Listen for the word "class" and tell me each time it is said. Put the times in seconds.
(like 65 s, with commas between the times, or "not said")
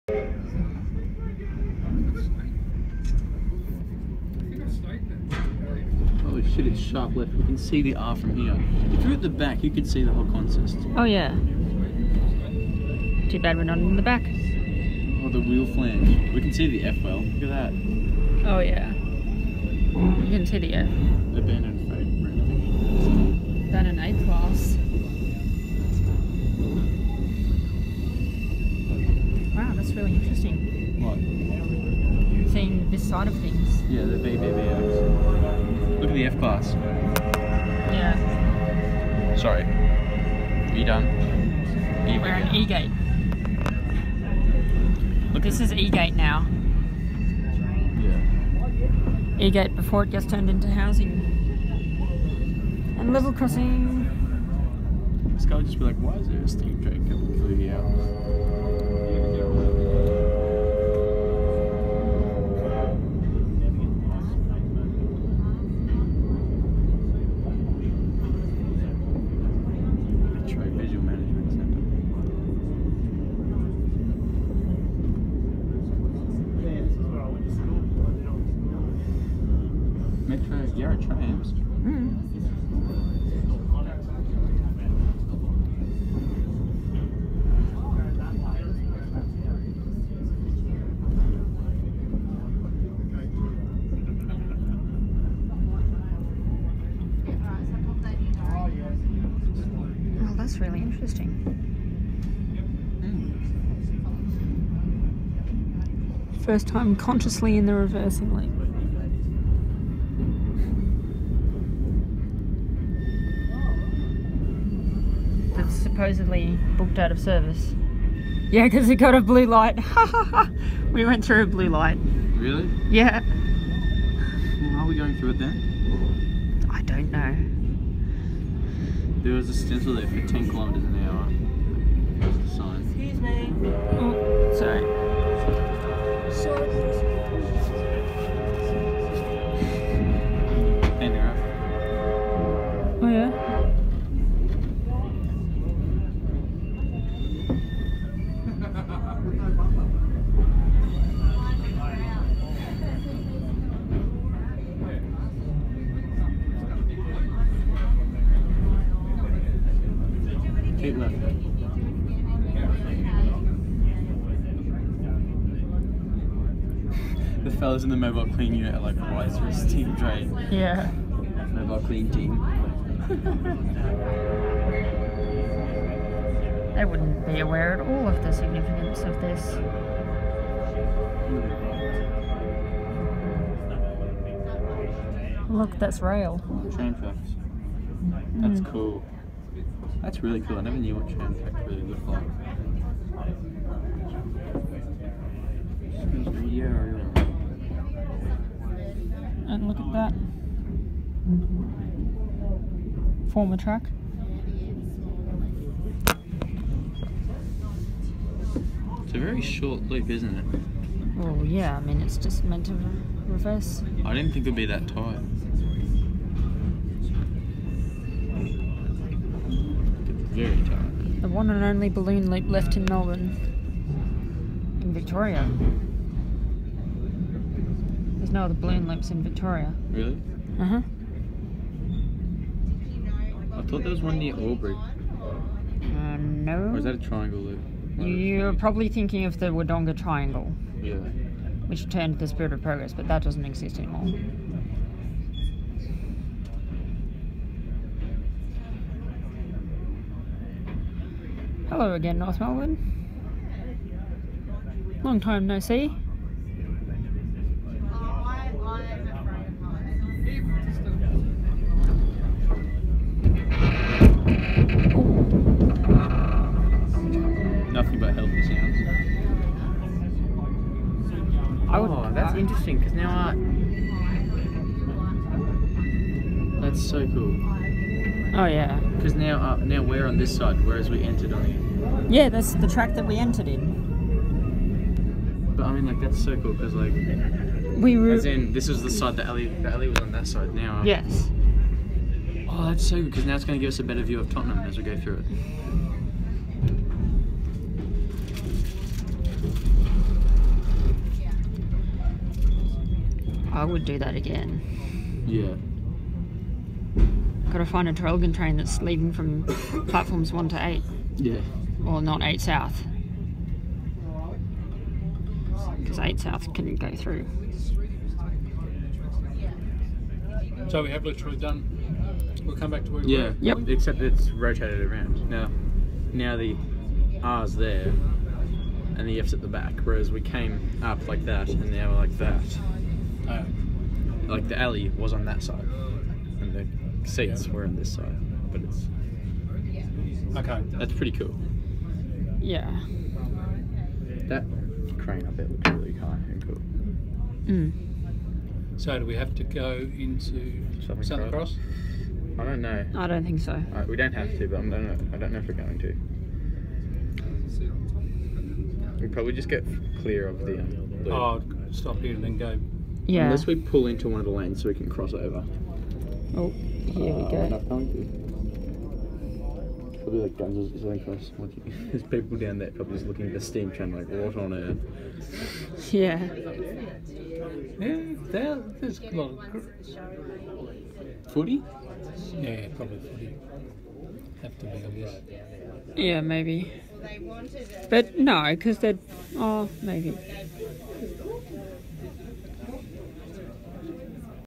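24 s, 36 s.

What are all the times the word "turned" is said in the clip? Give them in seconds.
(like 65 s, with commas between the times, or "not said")
50 s, 241 s.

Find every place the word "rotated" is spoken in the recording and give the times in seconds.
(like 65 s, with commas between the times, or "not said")
324 s.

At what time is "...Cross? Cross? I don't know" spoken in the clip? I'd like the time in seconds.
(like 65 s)
351 s.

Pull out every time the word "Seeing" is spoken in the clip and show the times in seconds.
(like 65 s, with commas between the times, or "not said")
32 s.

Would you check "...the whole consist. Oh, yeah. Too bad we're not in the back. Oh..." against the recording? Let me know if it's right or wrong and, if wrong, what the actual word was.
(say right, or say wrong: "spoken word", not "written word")
right.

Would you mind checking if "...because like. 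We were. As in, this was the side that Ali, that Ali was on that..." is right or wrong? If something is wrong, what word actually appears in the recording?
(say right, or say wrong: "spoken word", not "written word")
right.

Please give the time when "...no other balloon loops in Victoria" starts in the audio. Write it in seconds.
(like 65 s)
228 s.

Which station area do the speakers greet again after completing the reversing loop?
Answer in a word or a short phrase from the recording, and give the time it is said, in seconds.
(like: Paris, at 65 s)
North Melbourne, at 252 s.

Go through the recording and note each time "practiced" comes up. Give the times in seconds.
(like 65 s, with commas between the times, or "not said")
not said.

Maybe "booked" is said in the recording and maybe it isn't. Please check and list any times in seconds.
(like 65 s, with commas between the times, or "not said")
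116 s.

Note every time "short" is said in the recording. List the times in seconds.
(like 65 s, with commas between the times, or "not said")
209 s.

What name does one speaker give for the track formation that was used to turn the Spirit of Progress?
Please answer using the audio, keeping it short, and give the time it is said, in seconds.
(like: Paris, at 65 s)
Wodonga Triangle, at 239 s.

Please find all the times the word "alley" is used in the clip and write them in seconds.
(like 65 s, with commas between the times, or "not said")
334 s.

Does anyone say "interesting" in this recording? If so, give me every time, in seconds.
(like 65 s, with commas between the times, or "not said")
30 s, 100 s, 272 s.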